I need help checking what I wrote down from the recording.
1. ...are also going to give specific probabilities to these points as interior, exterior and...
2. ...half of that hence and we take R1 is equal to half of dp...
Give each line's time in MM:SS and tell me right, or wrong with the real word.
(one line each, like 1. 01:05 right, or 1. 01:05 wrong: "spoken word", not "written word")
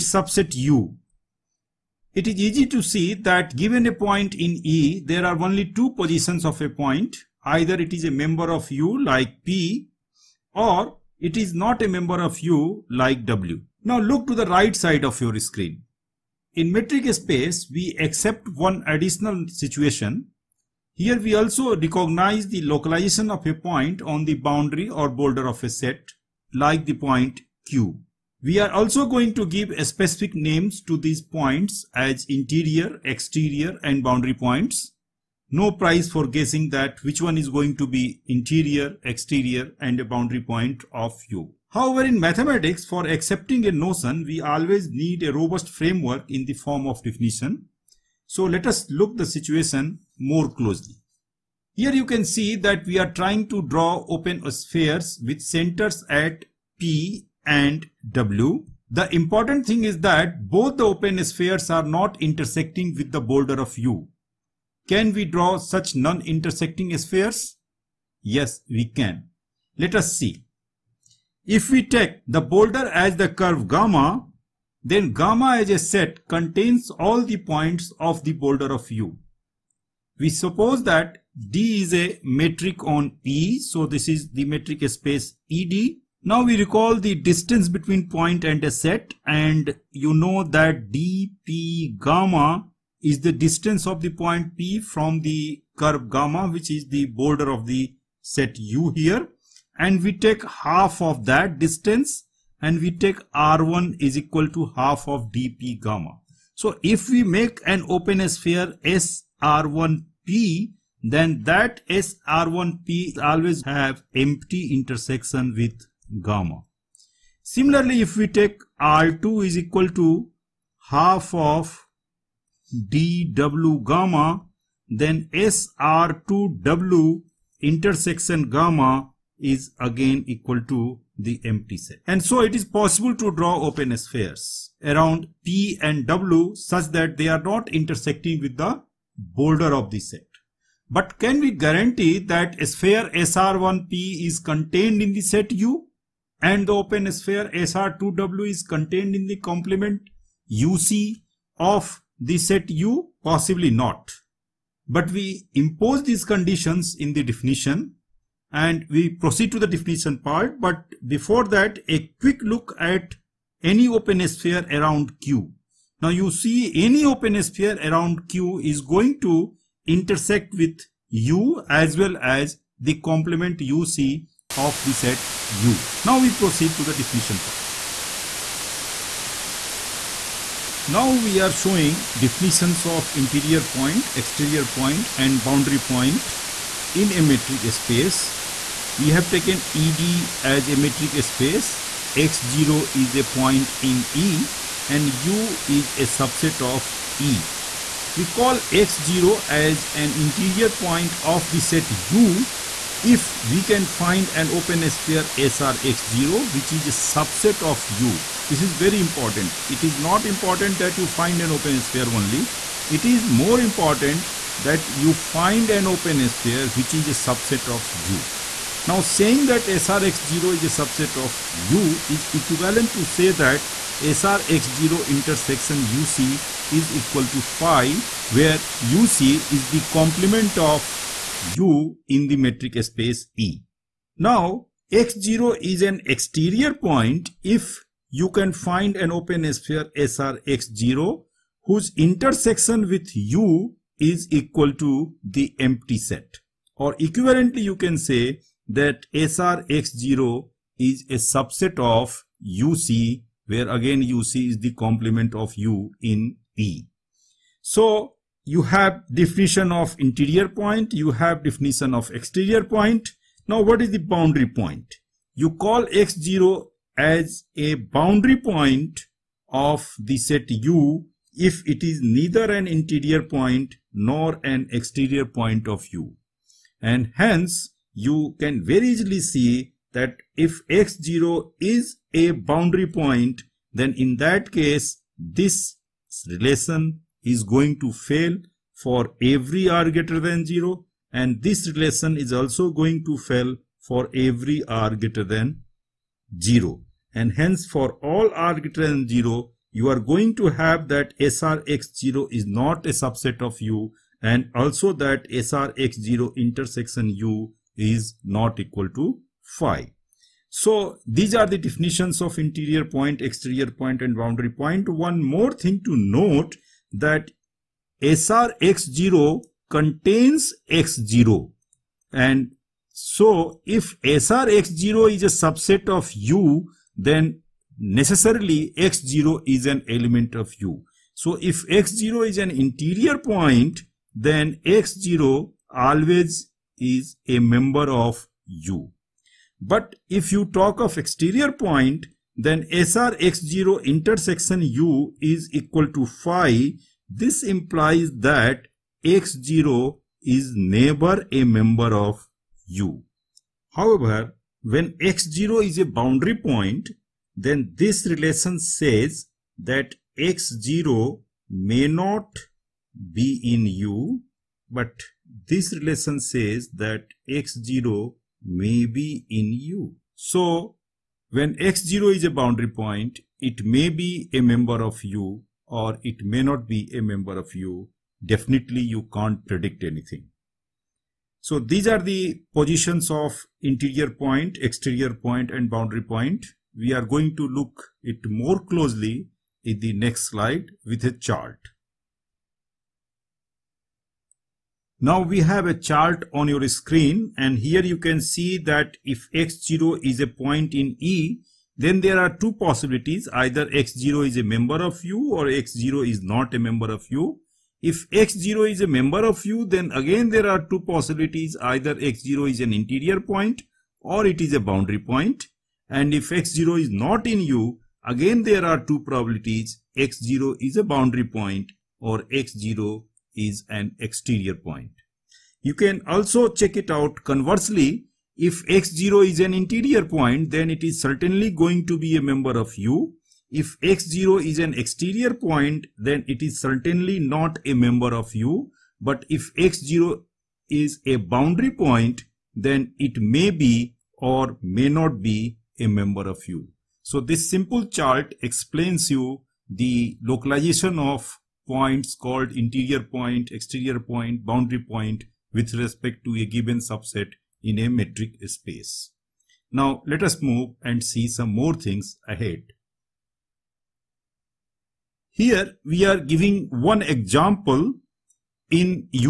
1. 00:28 wrong: "names", not "probabilities"
2. 01:40 wrong: "distance", not "hence".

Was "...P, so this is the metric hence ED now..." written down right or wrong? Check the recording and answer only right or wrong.
wrong.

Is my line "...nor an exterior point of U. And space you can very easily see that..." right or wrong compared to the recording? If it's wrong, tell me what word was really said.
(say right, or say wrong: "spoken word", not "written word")
wrong: "hence", not "space".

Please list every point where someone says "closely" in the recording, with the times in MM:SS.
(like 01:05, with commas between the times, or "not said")
00:50, 06:28.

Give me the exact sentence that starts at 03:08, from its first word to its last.
We have taken ED as a metric space, X0 is a point in E and U is a subset of E.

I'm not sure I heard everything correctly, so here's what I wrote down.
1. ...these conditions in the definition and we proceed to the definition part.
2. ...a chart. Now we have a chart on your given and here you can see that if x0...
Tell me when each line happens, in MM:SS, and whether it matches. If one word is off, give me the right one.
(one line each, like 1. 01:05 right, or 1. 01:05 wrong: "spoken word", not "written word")
1. 02:36 right
2. 06:31 wrong: "screen", not "given".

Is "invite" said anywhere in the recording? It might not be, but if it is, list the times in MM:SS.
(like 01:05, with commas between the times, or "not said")
not said.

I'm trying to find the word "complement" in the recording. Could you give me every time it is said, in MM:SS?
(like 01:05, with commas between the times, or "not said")
02:29, 02:53, 03:49, 04:14.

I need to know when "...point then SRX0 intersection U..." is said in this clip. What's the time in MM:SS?
05:41.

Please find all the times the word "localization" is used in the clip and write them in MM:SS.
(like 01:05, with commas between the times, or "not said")
00:22, 07:30.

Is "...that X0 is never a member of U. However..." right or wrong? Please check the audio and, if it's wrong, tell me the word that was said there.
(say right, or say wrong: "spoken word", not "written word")
right.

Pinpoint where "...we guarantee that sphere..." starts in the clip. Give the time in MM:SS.
02:21.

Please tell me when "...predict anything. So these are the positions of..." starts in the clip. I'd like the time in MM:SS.
06:19.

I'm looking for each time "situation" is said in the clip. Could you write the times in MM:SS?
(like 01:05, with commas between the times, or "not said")
00:19, 00:49.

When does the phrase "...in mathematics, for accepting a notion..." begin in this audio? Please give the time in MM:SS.
00:42.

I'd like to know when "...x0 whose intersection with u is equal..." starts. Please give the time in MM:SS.
04:00.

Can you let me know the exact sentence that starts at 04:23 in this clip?
Now what is the boundary point?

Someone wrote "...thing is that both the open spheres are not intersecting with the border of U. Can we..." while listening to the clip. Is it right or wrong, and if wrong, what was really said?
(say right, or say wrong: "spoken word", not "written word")
right.